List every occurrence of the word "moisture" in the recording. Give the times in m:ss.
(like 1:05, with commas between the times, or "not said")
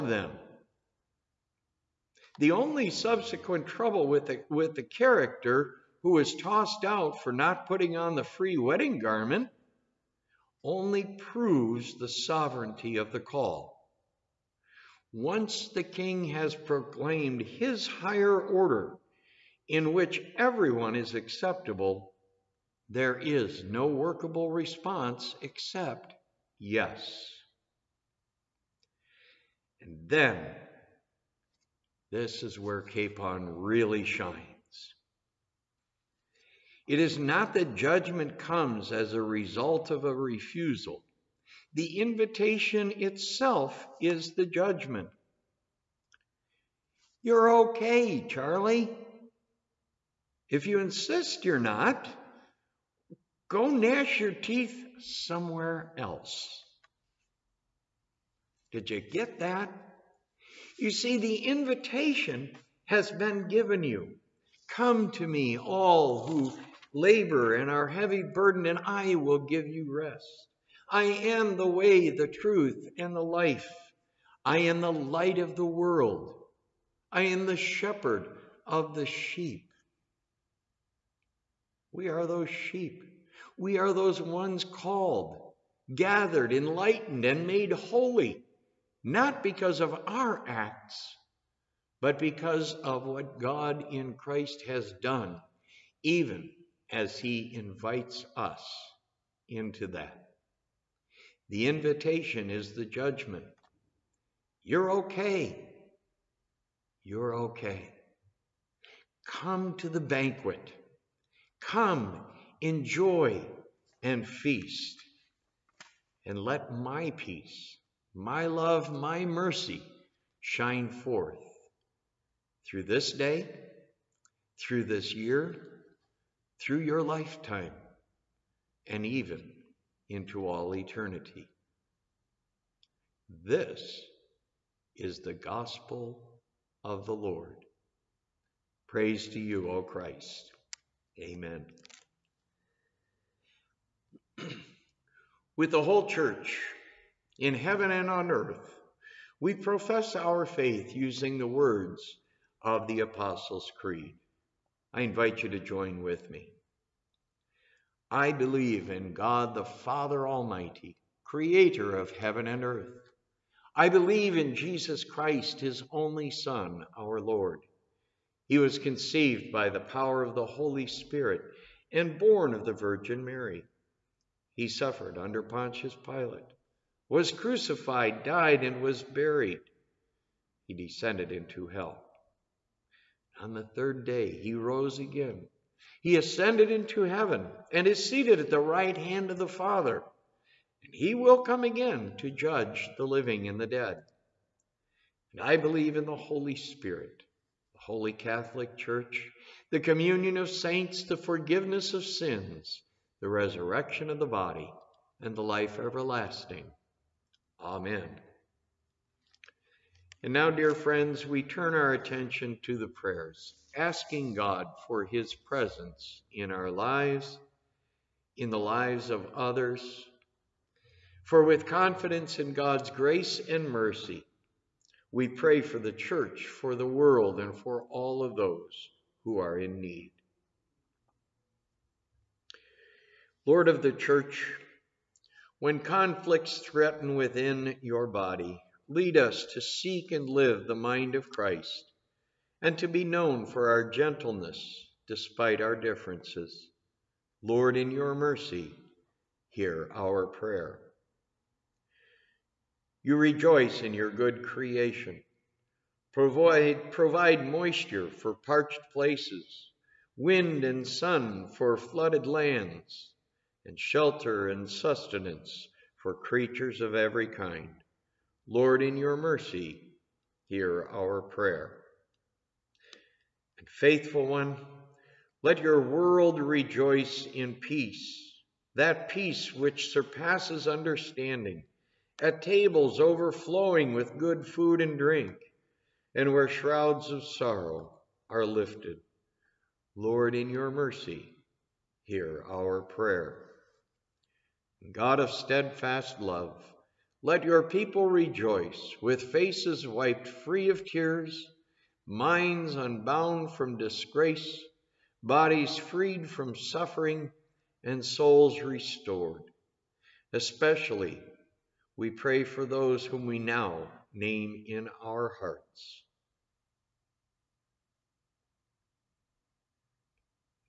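4:17.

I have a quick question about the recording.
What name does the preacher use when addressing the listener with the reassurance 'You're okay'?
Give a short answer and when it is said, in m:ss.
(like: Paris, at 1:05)
Charlie, at 0:48.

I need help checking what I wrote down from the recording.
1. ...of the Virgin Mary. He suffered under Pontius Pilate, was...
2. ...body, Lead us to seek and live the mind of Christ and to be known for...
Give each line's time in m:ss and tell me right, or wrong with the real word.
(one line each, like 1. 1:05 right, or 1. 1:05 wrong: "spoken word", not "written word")
1. 2:52 right
2. 3:58 right.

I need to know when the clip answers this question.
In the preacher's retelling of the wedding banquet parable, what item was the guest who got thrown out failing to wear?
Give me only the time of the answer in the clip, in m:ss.
0:08.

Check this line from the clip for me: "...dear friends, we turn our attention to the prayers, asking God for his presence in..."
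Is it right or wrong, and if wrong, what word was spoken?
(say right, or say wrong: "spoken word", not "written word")
right.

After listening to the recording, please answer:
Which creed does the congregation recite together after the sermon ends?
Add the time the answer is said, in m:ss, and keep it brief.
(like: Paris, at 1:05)
Apostles' Creed, at 2:32.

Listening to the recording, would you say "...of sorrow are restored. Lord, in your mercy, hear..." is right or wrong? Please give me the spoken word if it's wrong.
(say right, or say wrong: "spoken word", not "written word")
wrong: "lifted", not "restored".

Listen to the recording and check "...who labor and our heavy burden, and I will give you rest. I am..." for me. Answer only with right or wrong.
right.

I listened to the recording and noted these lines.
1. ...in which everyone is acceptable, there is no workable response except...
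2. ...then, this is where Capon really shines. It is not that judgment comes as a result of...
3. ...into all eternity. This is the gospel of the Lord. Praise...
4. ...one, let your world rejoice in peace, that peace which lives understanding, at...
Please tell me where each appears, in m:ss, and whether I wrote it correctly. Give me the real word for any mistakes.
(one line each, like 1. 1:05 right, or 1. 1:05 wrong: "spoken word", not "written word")
1. 0:19 right
2. 0:30 right
3. 2:10 right
4. 4:34 wrong: "surpasses", not "lives".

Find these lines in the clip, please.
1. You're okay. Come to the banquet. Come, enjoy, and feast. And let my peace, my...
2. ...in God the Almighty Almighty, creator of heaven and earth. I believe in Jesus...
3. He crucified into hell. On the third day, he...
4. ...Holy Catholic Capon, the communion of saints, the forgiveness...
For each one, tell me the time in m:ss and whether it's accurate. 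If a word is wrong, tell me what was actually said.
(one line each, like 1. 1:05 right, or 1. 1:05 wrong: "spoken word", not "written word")
1. 1:47 right
2. 2:38 wrong: "Father", not "Almighty"
3. 3:00 wrong: "descended", not "crucified"
4. 3:17 wrong: "Church", not "Capon".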